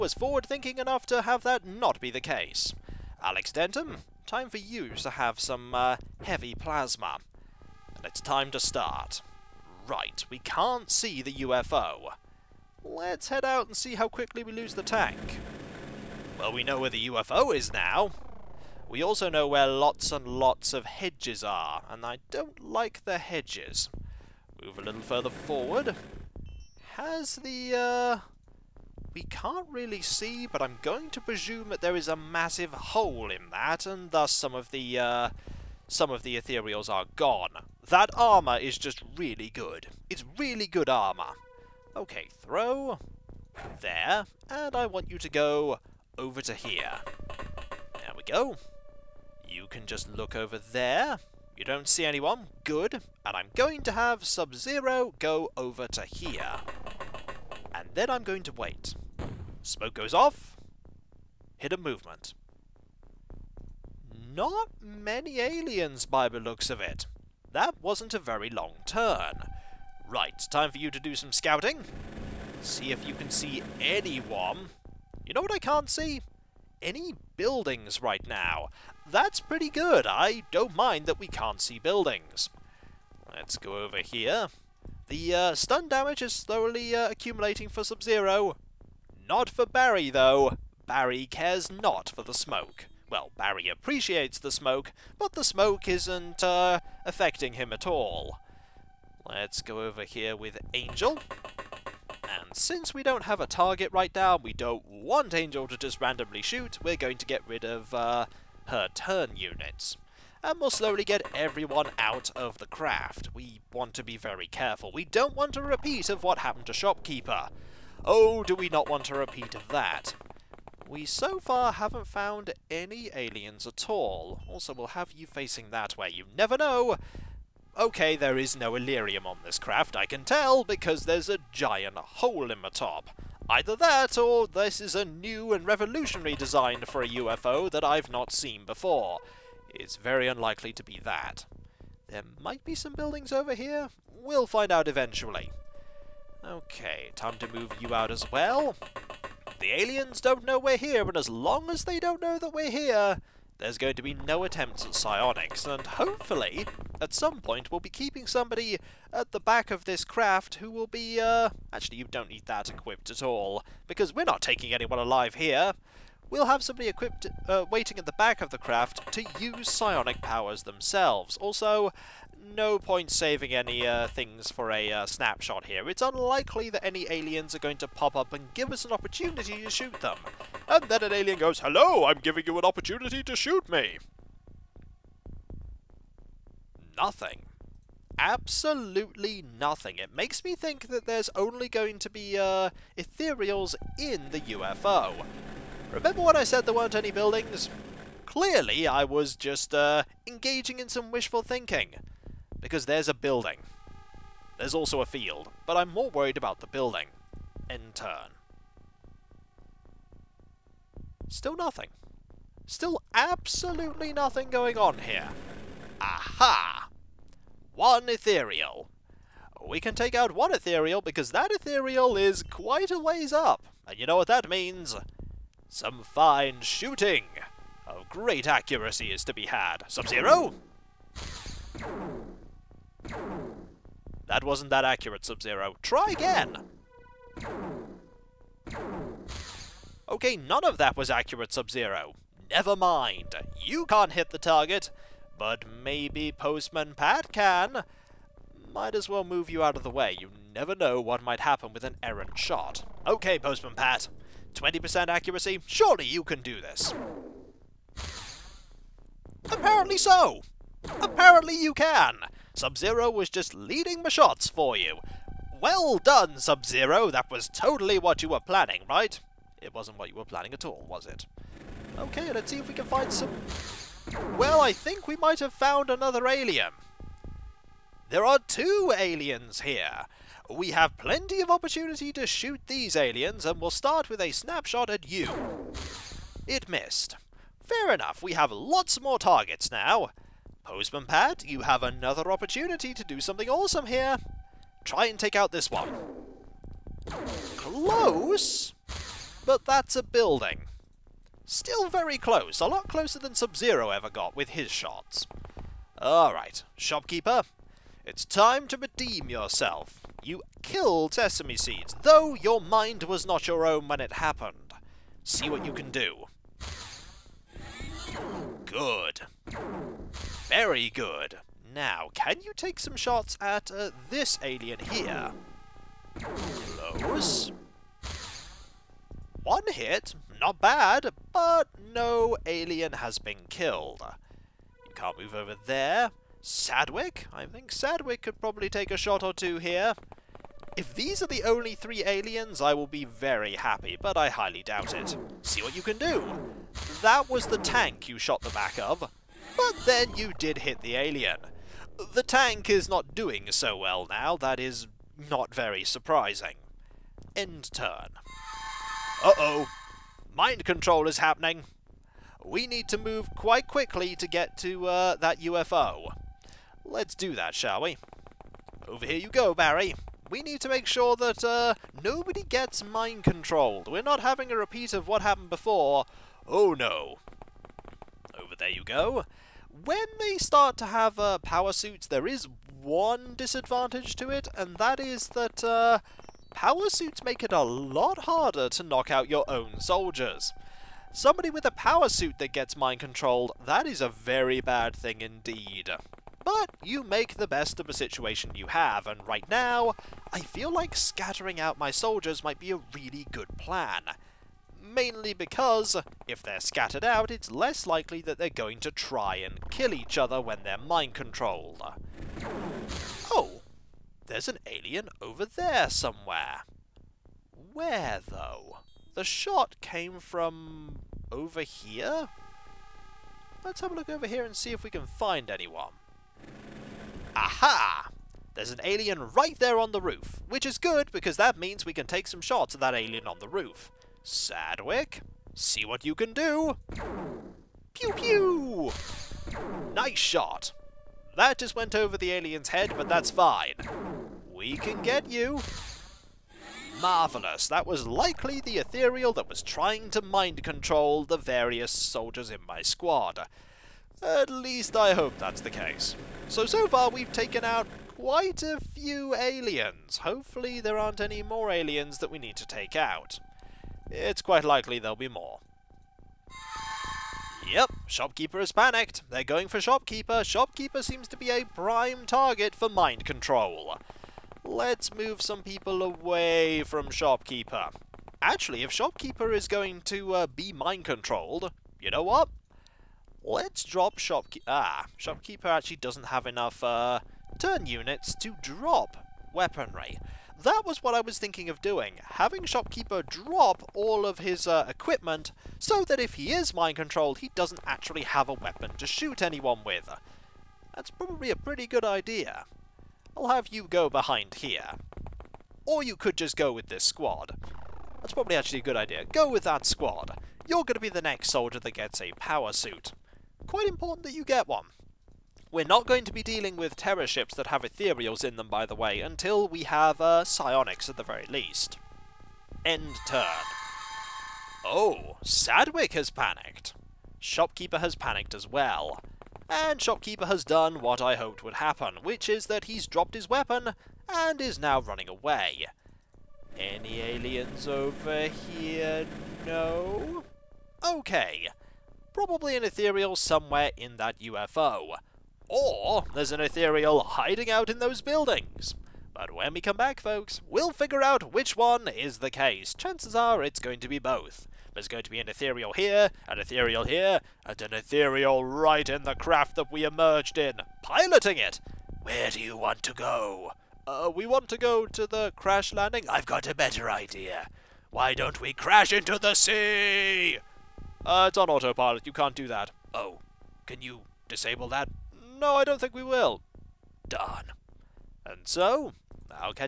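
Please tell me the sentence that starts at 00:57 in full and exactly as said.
And then I'm going to wait.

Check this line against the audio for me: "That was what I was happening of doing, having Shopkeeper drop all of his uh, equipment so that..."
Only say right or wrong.
wrong.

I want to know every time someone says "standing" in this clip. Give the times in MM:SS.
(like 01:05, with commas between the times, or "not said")
not said.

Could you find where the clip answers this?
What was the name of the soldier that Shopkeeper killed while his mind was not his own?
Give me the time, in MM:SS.
05:11.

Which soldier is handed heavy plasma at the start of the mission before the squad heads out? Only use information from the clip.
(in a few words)
Alex Denton.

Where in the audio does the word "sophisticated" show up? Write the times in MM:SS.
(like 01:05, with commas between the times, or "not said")
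not said.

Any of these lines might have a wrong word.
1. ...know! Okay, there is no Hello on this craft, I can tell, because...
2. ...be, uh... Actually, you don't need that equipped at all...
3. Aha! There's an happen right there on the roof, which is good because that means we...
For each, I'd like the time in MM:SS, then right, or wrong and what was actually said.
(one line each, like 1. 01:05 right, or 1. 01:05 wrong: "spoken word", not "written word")
1. 02:06 wrong: "Elerium", not "Hello"
2. 02:40 right
3. 07:07 wrong: "alien", not "happen".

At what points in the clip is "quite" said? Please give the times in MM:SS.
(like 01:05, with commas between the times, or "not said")
03:42, 06:03, 07:38, 07:44, 08:33.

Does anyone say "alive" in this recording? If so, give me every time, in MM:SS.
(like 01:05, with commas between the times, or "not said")
02:44.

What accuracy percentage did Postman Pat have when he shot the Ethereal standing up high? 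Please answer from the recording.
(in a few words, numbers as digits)
20%.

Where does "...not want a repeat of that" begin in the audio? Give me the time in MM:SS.
01:58.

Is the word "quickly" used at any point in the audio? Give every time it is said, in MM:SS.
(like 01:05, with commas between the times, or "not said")
00:14, 06:03.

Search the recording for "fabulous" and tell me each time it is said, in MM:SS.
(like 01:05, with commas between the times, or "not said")
not said.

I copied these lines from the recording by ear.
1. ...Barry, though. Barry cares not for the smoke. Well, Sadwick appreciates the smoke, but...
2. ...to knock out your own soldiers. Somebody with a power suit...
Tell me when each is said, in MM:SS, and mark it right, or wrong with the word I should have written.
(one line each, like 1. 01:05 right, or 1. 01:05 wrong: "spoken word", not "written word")
1. 01:29 wrong: "Barry", not "Sadwick"
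2. 06:28 right.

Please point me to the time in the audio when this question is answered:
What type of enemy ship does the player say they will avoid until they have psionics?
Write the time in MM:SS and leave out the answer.
08:36.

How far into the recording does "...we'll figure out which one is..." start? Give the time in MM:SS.
09:10.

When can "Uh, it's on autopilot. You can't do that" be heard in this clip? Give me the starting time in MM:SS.
09:31.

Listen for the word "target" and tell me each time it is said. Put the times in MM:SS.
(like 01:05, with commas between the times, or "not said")
01:43, 04:04, 04:49, 07:52.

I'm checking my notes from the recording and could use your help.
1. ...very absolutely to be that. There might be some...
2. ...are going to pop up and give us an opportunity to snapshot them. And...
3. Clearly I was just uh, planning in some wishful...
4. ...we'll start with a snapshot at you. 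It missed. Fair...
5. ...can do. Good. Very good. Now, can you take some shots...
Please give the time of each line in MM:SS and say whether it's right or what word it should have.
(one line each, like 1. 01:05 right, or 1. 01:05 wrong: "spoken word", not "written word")
1. 02:19 wrong: "unlikely", not "absolutely"
2. 02:57 wrong: "shoot", not "snapshot"
3. 03:18 wrong: "engaging", not "planning"
4. 04:43 right
5. 05:15 right.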